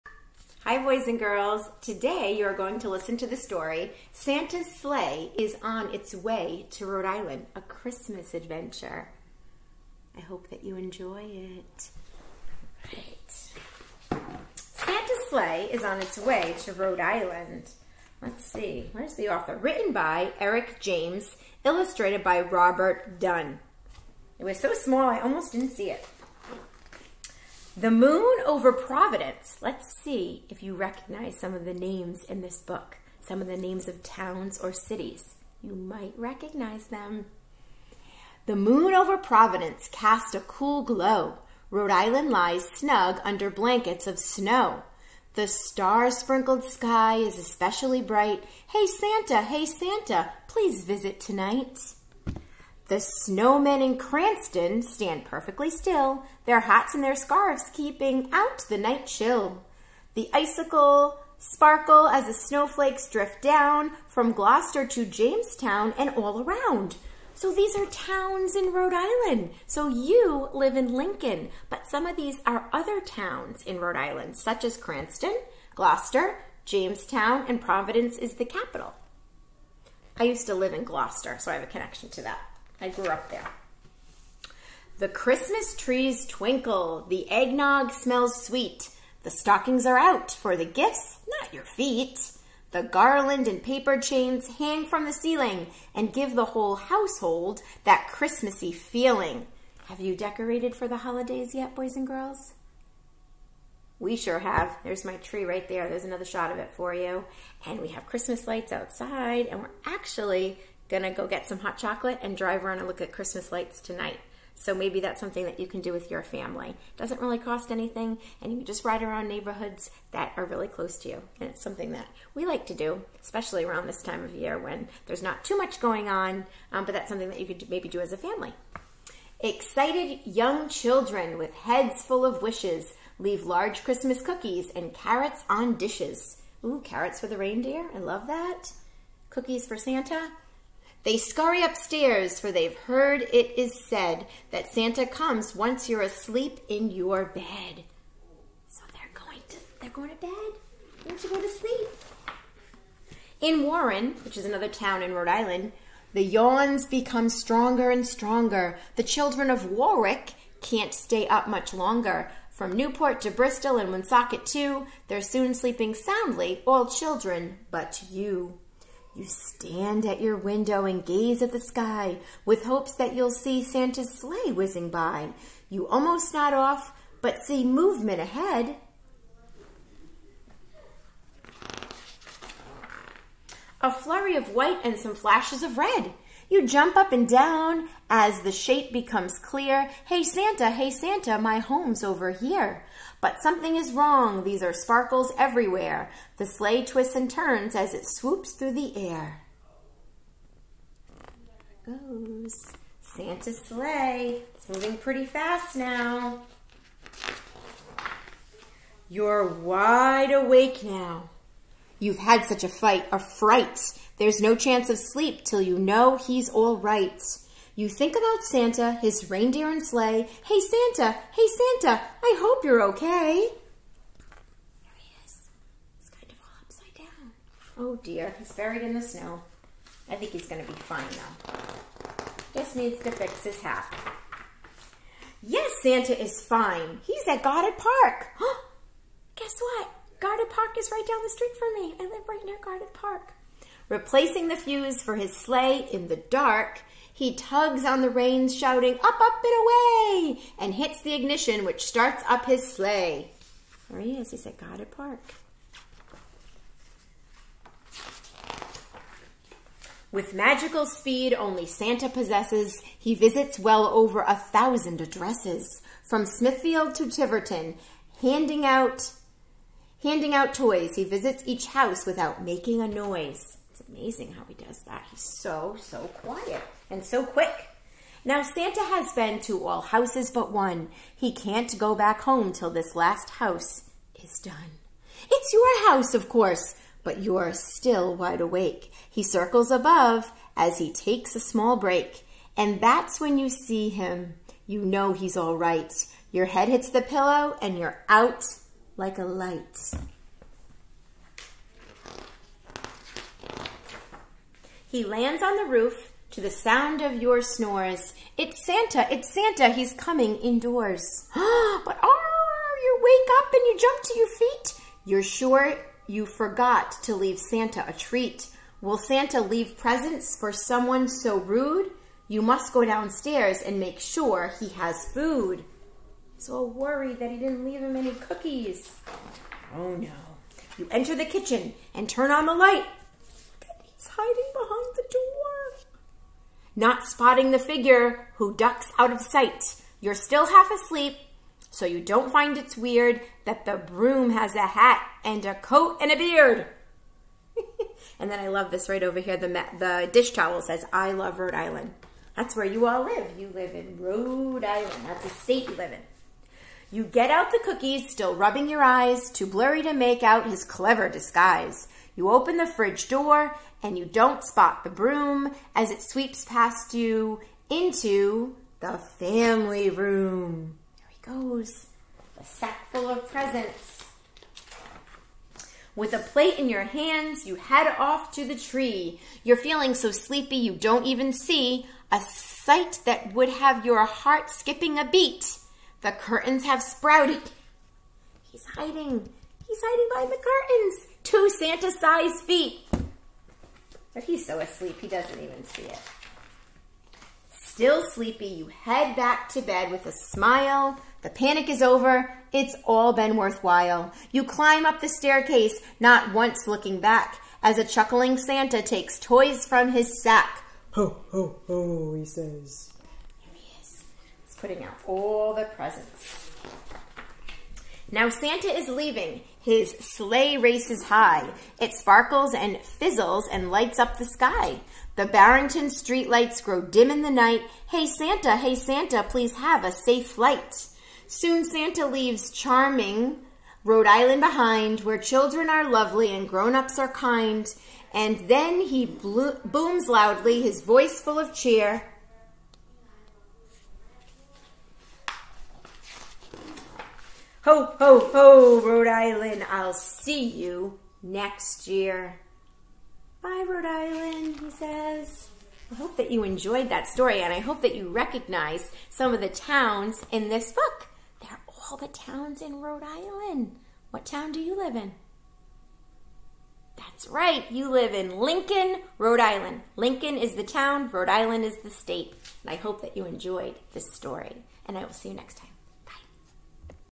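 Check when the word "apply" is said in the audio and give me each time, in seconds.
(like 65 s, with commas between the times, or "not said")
not said.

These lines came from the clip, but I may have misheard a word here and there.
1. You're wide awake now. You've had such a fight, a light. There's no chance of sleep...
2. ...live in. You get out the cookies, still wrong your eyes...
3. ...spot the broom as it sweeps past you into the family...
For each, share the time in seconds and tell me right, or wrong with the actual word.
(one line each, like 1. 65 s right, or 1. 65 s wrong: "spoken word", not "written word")
1. 209 s wrong: "fright", not "light"
2. 355 s wrong: "rubbing", not "wrong"
3. 364 s right.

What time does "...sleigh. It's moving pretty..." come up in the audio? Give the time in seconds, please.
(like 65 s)
203 s.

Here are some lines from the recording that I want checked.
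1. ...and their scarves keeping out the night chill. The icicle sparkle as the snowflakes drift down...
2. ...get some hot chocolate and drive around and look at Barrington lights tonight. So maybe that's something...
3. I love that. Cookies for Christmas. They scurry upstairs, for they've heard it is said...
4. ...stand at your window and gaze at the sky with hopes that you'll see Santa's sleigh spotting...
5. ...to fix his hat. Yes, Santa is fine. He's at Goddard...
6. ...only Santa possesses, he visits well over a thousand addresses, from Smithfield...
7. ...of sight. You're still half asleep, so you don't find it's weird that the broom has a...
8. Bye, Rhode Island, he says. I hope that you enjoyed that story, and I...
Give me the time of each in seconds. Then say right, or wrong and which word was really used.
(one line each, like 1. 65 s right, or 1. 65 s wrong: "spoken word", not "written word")
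1. 56 s right
2. 111 s wrong: "Christmas", not "Barrington"
3. 137 s wrong: "Santa", not "Christmas"
4. 169 s wrong: "whizzing", not "spotting"
5. 233 s right
6. 261 s right
7. 339 s right
8. 453 s right.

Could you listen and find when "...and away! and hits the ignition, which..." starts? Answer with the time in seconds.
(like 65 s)
249 s.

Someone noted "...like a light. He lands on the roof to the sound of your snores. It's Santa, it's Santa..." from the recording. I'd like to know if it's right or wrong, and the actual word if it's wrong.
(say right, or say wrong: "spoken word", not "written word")
right.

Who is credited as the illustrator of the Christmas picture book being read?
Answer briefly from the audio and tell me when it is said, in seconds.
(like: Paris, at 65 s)
Robert Dunn, at 22 s.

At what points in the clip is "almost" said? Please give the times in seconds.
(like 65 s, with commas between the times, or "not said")
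25 s, 175 s.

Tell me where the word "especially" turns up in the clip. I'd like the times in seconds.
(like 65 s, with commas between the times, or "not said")
47 s, 123 s.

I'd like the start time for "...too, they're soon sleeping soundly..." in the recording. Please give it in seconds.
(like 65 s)
164 s.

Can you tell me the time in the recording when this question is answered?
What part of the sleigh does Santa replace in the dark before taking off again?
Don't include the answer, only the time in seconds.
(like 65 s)
243 s.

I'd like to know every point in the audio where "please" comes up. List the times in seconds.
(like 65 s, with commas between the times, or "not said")
50 s, 429 s.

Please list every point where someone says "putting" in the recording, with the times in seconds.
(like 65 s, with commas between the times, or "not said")
414 s.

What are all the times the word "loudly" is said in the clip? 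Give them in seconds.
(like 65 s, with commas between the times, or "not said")
440 s.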